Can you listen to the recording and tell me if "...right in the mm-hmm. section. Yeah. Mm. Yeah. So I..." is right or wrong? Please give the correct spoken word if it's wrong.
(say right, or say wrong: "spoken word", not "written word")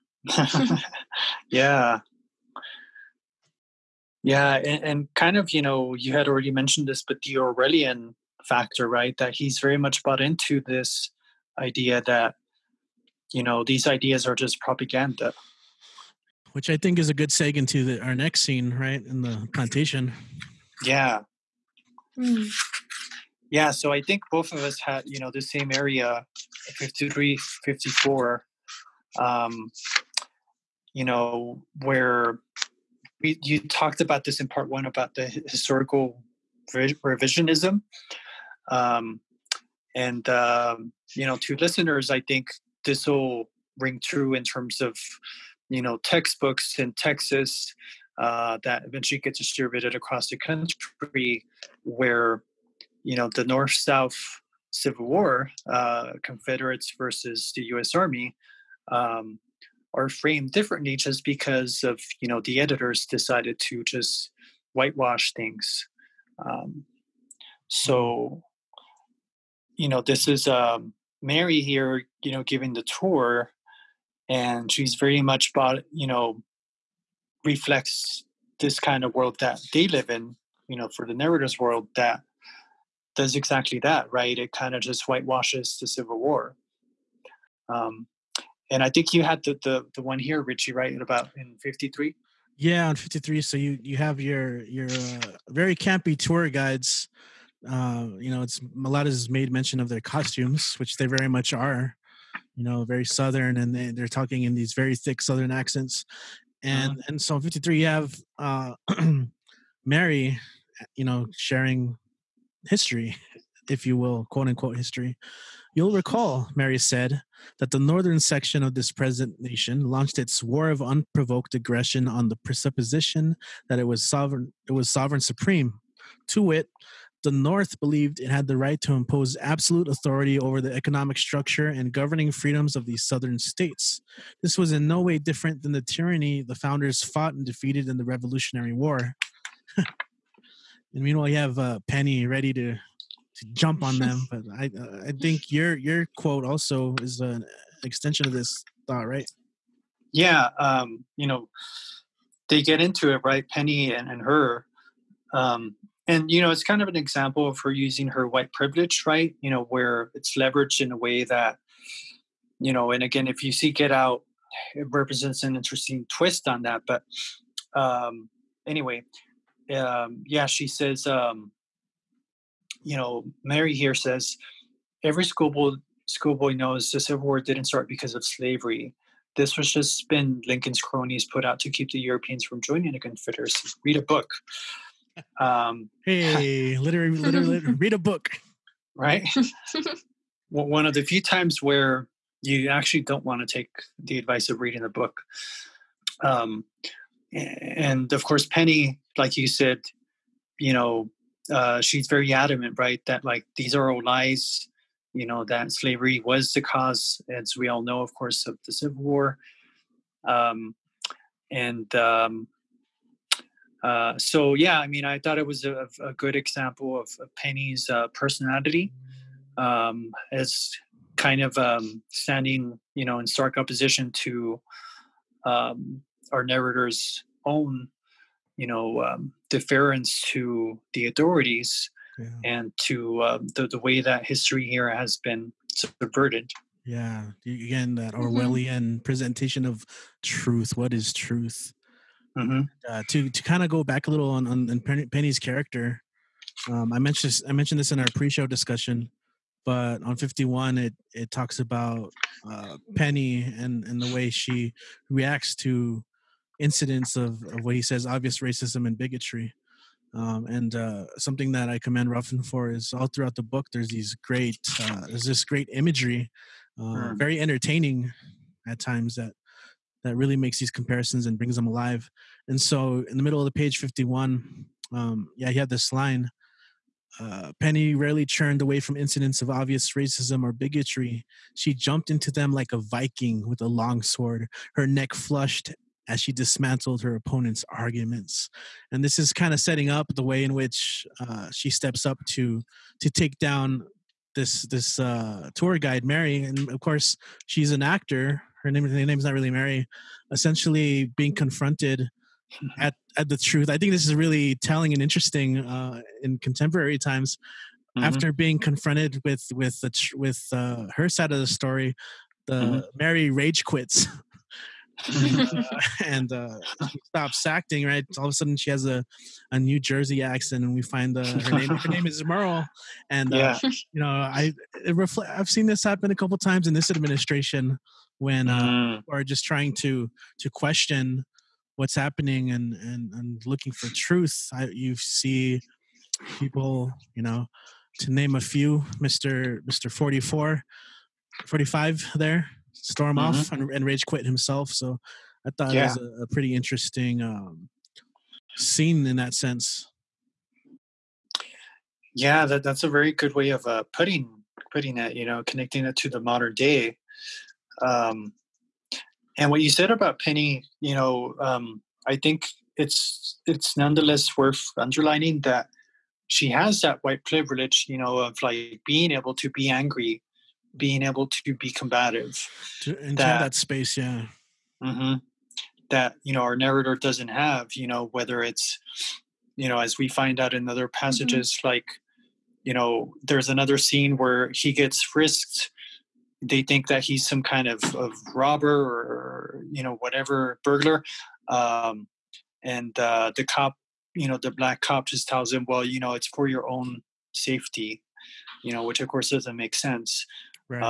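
wrong: "plantation", not "section".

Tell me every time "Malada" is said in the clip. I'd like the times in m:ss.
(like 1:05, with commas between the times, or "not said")
1:38.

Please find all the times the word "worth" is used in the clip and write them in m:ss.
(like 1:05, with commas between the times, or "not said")
6:04.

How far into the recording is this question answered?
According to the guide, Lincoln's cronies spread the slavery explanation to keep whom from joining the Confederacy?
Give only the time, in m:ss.
3:01.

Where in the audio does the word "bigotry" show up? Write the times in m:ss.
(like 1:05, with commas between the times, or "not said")
4:18, 4:40.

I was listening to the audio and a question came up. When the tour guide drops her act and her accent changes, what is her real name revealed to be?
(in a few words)
Merle.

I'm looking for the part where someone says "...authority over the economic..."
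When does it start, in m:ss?
2:09.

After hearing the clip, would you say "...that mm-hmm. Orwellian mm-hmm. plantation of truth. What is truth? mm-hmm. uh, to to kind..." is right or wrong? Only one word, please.
wrong.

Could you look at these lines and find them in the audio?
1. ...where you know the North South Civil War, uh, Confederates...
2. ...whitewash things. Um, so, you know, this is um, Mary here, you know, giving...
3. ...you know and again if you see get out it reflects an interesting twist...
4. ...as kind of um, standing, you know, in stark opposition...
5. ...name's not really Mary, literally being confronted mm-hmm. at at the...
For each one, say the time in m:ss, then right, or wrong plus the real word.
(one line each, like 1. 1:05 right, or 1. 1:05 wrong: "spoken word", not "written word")
1. 0:51 right
2. 1:04 right
3. 2:42 wrong: "represents", not "reflects"
4. 3:40 right
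5. 4:59 wrong: "essentially", not "literally".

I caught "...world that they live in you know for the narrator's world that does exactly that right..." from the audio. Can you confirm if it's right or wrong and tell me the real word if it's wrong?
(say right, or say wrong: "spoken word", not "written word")
right.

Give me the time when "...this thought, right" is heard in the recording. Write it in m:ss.
2:28.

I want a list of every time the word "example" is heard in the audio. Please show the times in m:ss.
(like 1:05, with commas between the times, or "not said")
2:36, 3:36.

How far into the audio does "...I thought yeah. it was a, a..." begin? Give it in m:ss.
5:45.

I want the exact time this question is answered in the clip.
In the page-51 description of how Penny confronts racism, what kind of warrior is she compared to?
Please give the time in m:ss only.
4:42.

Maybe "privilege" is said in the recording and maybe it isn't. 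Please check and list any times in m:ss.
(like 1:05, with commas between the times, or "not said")
2:38, 6:07.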